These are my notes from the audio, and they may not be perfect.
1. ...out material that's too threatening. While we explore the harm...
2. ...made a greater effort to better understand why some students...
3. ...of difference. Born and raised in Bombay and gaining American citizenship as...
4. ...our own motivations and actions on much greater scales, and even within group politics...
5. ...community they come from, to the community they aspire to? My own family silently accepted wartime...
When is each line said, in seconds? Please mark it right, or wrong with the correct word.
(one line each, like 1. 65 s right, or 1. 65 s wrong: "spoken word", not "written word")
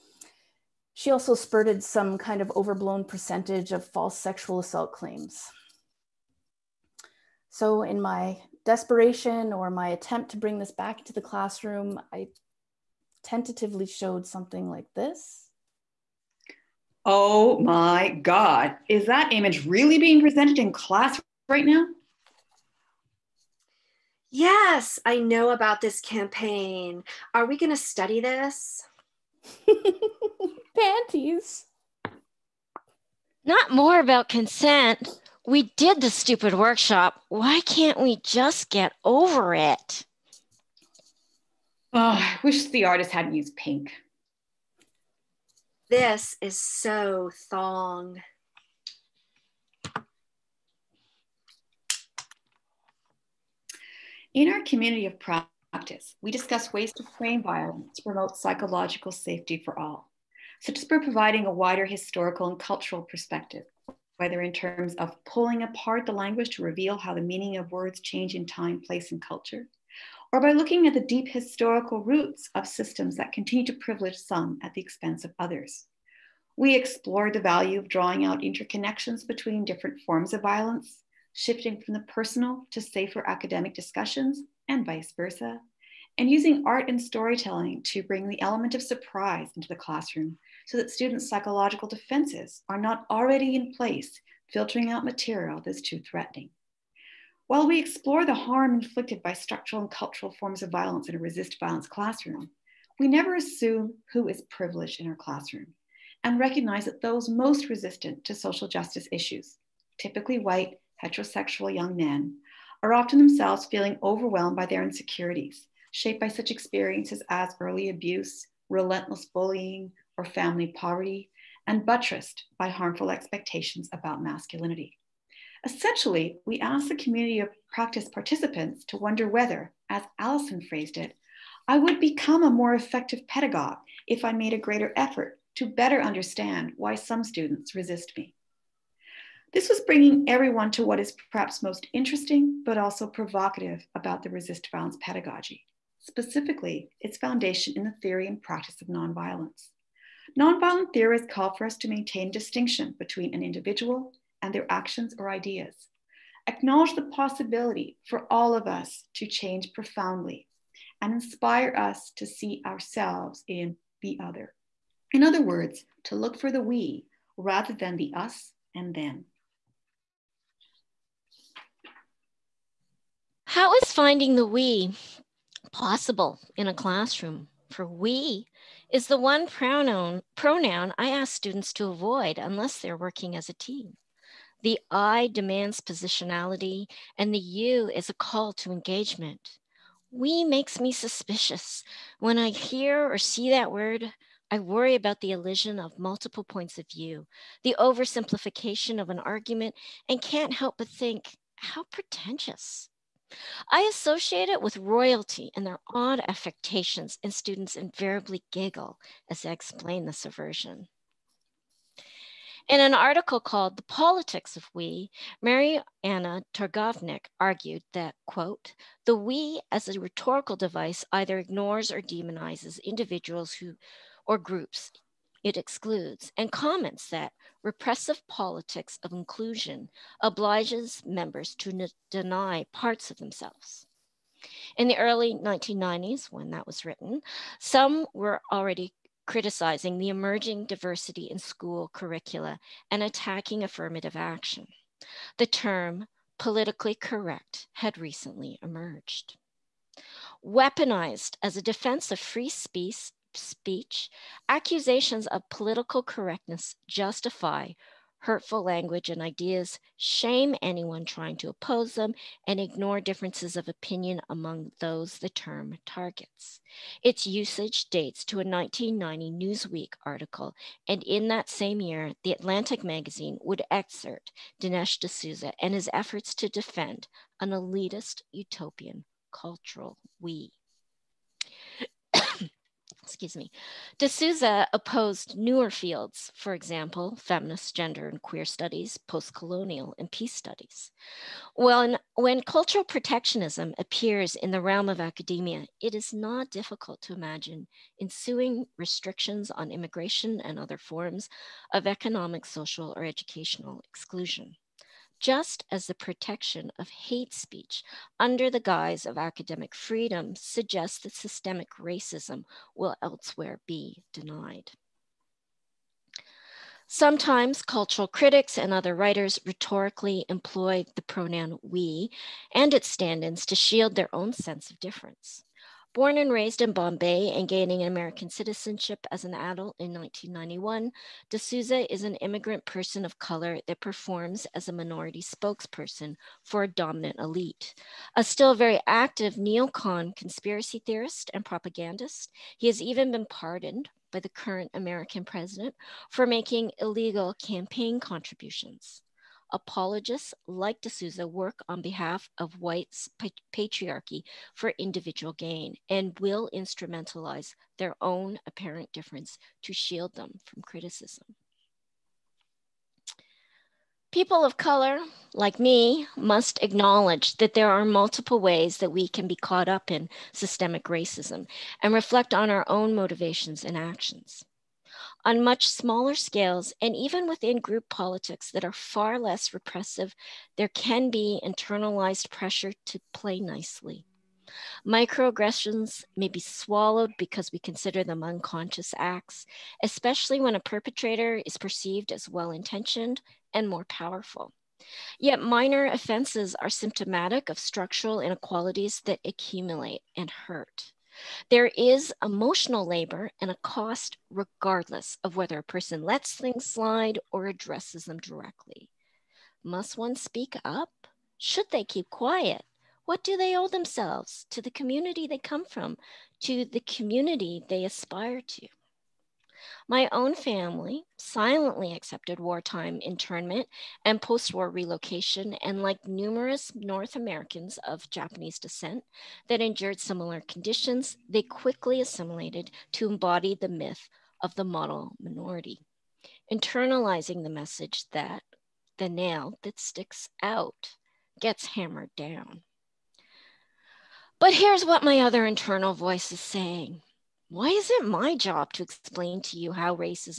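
1. 94 s right
2. 134 s right
3. 324 s right
4. 372 s wrong: "smaller", not "greater"
5. 414 s right.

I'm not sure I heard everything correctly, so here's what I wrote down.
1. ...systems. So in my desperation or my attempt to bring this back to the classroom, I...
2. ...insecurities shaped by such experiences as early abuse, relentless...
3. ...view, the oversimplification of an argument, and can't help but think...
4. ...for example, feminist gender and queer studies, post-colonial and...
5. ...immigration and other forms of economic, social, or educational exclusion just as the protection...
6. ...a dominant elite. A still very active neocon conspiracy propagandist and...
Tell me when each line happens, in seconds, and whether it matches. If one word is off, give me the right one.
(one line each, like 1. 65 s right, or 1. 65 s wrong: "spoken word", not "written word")
1. 4 s wrong: "claims", not "systems"
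2. 114 s right
3. 196 s right
4. 286 s right
5. 299 s right
6. 336 s wrong: "theorist", not "propagandist".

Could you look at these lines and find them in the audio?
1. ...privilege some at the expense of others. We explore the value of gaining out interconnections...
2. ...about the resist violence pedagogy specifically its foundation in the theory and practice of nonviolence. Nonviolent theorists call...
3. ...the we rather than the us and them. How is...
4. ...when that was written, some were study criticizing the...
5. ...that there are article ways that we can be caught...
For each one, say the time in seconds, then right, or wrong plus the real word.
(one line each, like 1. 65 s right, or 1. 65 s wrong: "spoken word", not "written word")
1. 73 s wrong: "drawing", not "gaining"
2. 143 s right
3. 166 s right
4. 236 s wrong: "already", not "study"
5. 367 s wrong: "multiple", not "article".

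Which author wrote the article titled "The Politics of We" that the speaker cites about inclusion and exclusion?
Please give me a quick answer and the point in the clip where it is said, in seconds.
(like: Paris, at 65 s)
Mary Anna Targovnik, at 215 s.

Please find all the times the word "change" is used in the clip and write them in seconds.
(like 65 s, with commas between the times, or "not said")
68 s, 159 s.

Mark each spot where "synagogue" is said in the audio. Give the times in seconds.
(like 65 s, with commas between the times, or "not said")
not said.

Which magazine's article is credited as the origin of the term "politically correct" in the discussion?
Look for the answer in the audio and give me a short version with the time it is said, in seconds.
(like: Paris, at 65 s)
Newsweek, at 269 s.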